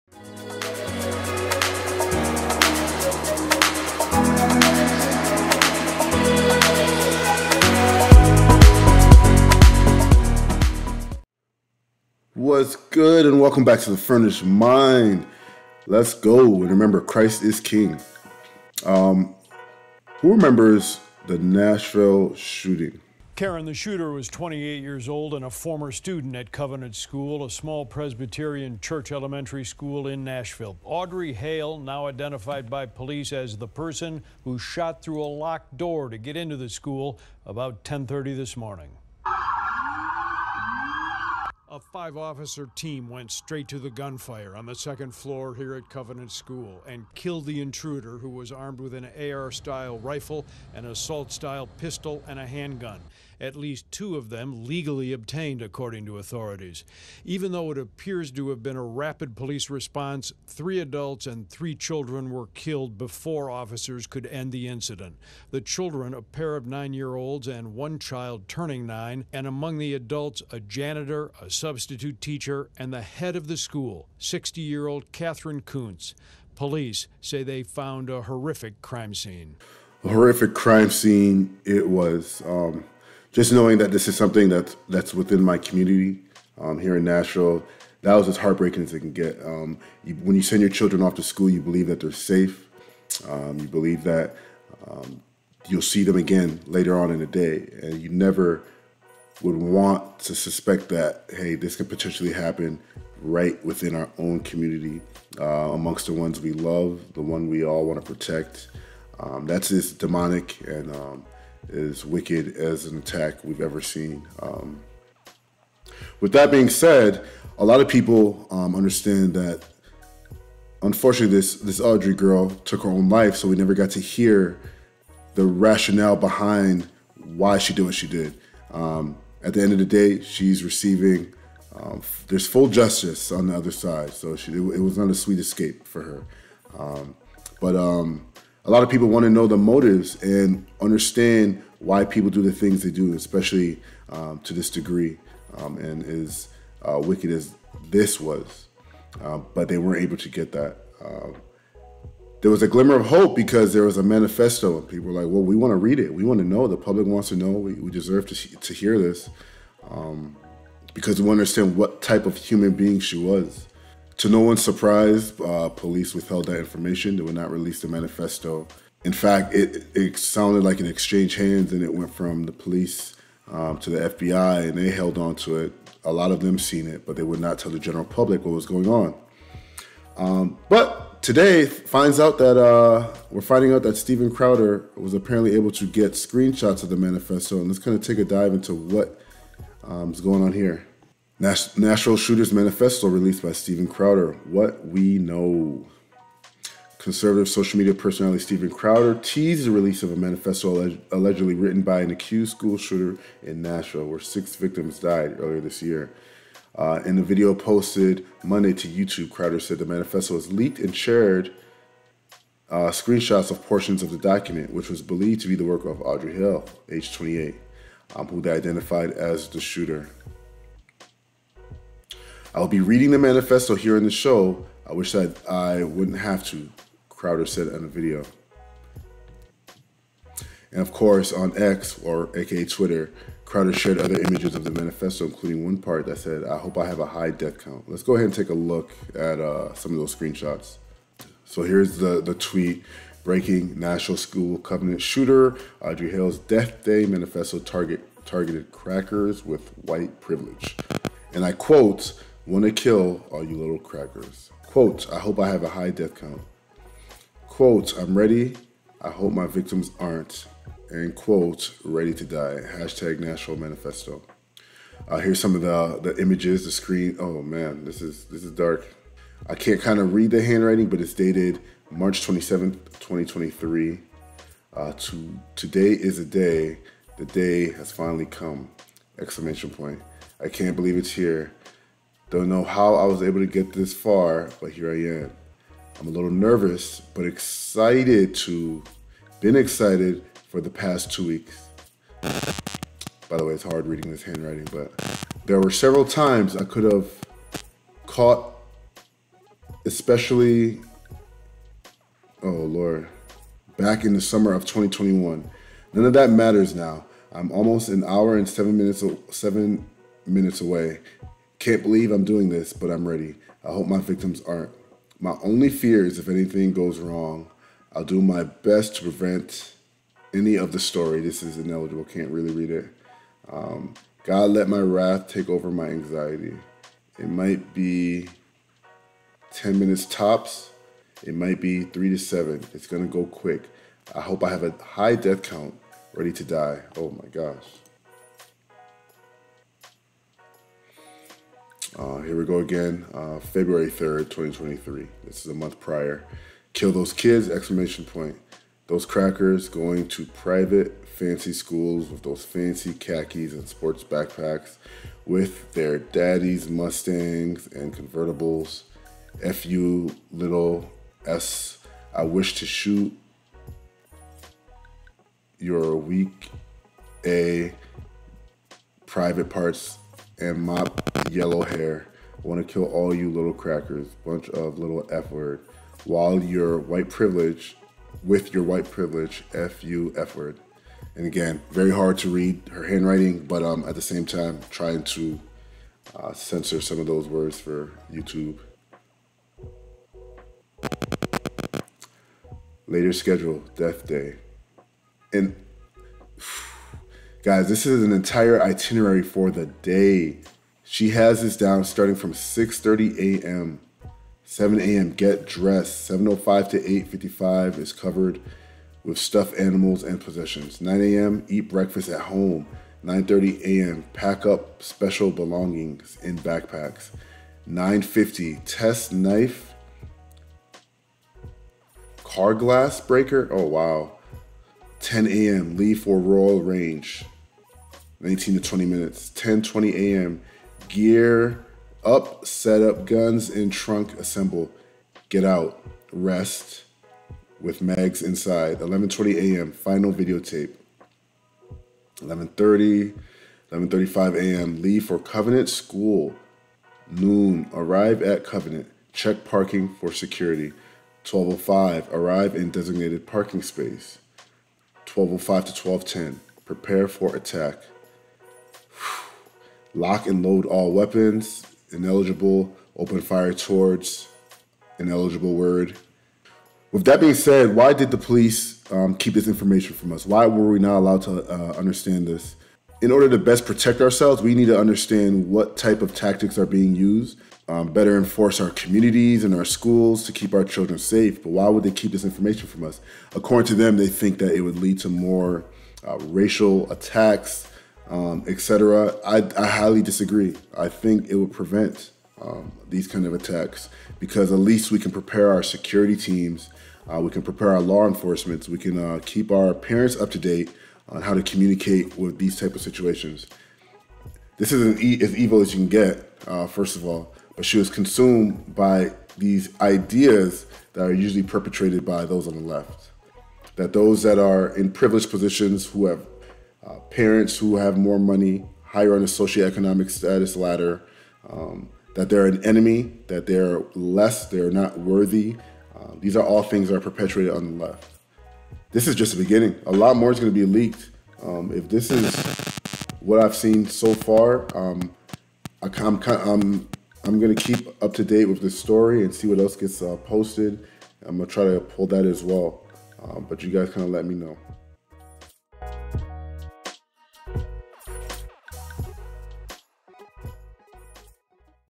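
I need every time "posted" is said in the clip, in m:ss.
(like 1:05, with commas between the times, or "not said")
3:27, 9:00.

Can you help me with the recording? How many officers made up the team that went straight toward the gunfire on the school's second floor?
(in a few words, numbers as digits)
5.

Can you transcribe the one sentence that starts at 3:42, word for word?
I'll be reading the manifesto here in the show.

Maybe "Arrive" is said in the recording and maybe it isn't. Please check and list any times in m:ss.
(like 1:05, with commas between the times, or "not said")
7:27, 7:32.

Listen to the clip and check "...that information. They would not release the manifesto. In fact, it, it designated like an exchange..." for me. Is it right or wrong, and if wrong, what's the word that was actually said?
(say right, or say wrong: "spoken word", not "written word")
wrong: "sounded", not "designated".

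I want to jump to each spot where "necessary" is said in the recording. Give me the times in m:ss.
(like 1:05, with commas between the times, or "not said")
not said.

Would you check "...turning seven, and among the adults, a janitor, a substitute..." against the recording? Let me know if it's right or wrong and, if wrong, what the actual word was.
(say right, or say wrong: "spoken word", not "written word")
wrong: "nine", not "seven".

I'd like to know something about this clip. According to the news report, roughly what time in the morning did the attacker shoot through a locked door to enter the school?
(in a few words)
10:30.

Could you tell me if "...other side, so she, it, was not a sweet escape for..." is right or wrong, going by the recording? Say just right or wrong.
right.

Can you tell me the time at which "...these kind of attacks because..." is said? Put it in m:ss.
8:12.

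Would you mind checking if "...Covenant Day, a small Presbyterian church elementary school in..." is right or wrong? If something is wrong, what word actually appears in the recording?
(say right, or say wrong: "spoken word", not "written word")
wrong: "School", not "Day".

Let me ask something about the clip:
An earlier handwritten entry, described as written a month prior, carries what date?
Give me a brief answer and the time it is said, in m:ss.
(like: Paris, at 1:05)
February 3rd, 2023, at 5:43.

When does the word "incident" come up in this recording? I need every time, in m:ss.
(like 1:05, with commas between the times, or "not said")
1:04.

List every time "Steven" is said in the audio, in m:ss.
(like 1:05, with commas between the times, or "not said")
3:03, 3:13, 3:18.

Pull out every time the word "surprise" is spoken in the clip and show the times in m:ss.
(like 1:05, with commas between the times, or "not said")
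2:44.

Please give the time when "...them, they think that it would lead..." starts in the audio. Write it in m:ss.
8:03.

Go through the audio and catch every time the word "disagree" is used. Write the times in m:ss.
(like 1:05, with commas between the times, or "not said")
8:10.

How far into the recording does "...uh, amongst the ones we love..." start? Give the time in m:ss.
1:45.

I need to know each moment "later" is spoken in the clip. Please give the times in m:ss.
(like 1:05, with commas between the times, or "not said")
1:36, 6:32.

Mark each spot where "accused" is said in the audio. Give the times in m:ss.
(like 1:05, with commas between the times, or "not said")
3:22.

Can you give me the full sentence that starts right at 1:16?
Police say they found a horrific crime scene.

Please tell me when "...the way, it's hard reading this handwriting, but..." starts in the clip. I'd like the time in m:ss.
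4:53.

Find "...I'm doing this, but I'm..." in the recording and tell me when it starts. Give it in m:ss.
5:12.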